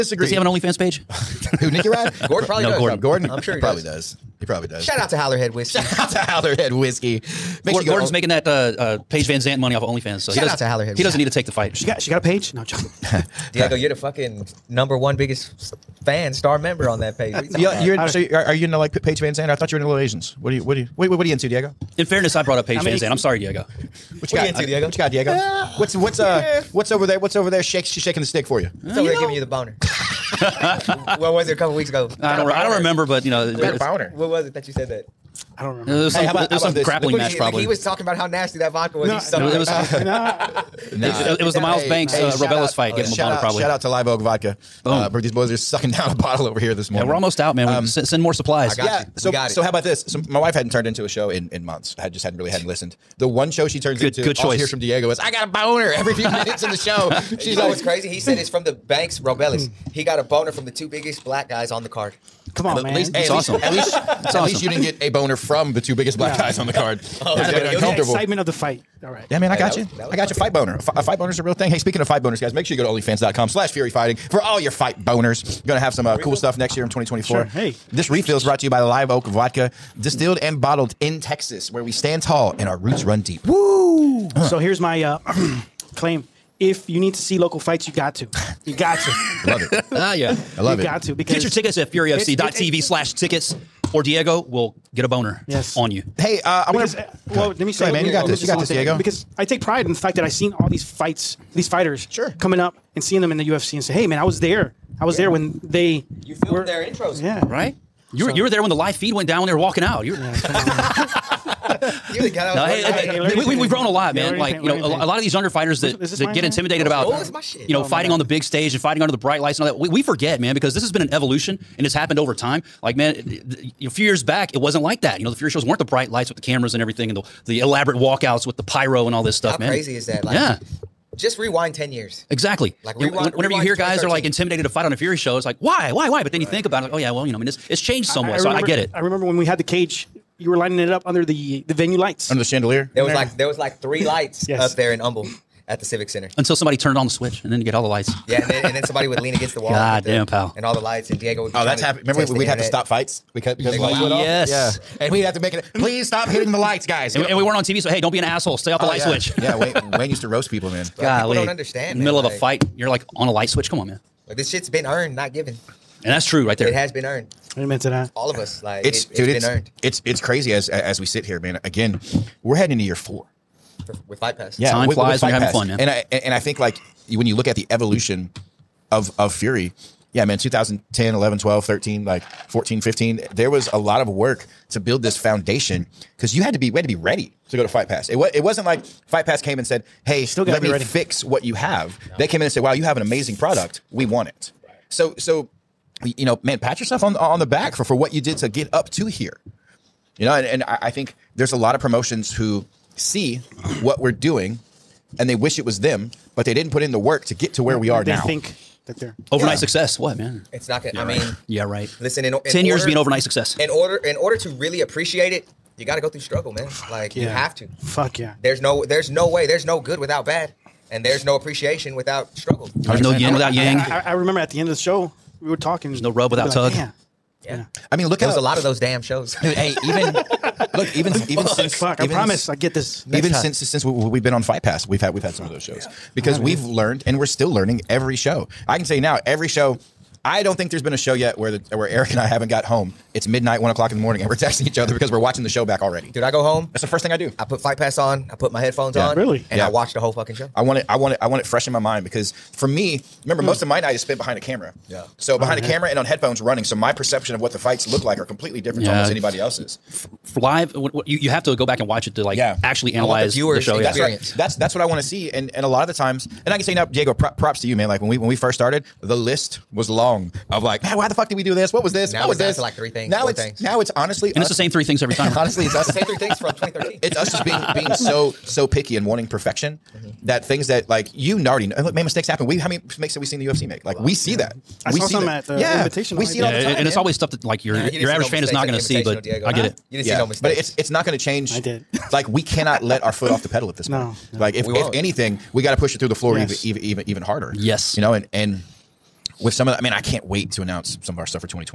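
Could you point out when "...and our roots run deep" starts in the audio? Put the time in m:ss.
1:22.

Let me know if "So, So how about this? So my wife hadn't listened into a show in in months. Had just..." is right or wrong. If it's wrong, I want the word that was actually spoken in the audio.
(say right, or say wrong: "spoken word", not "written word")
wrong: "turned", not "listened".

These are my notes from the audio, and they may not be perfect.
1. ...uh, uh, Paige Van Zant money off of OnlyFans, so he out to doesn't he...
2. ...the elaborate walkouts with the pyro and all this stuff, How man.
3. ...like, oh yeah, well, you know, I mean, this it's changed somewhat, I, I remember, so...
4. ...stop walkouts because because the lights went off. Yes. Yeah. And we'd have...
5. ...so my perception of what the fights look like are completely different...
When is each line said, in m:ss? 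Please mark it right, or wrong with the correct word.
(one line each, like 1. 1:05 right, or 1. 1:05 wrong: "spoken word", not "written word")
1. 0:08 right
2. 2:07 right
3. 2:16 right
4. 2:32 wrong: "fights", not "walkouts"
5. 4:16 right.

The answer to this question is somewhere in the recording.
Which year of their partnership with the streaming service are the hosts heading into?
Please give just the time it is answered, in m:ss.
2:52.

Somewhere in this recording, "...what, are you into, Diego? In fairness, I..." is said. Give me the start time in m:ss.
0:21.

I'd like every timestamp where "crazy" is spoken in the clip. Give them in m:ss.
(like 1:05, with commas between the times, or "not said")
0:57, 2:09, 2:50.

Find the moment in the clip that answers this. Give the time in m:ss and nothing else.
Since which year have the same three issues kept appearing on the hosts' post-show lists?
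4:36.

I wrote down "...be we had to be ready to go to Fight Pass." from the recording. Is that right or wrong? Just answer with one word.
right.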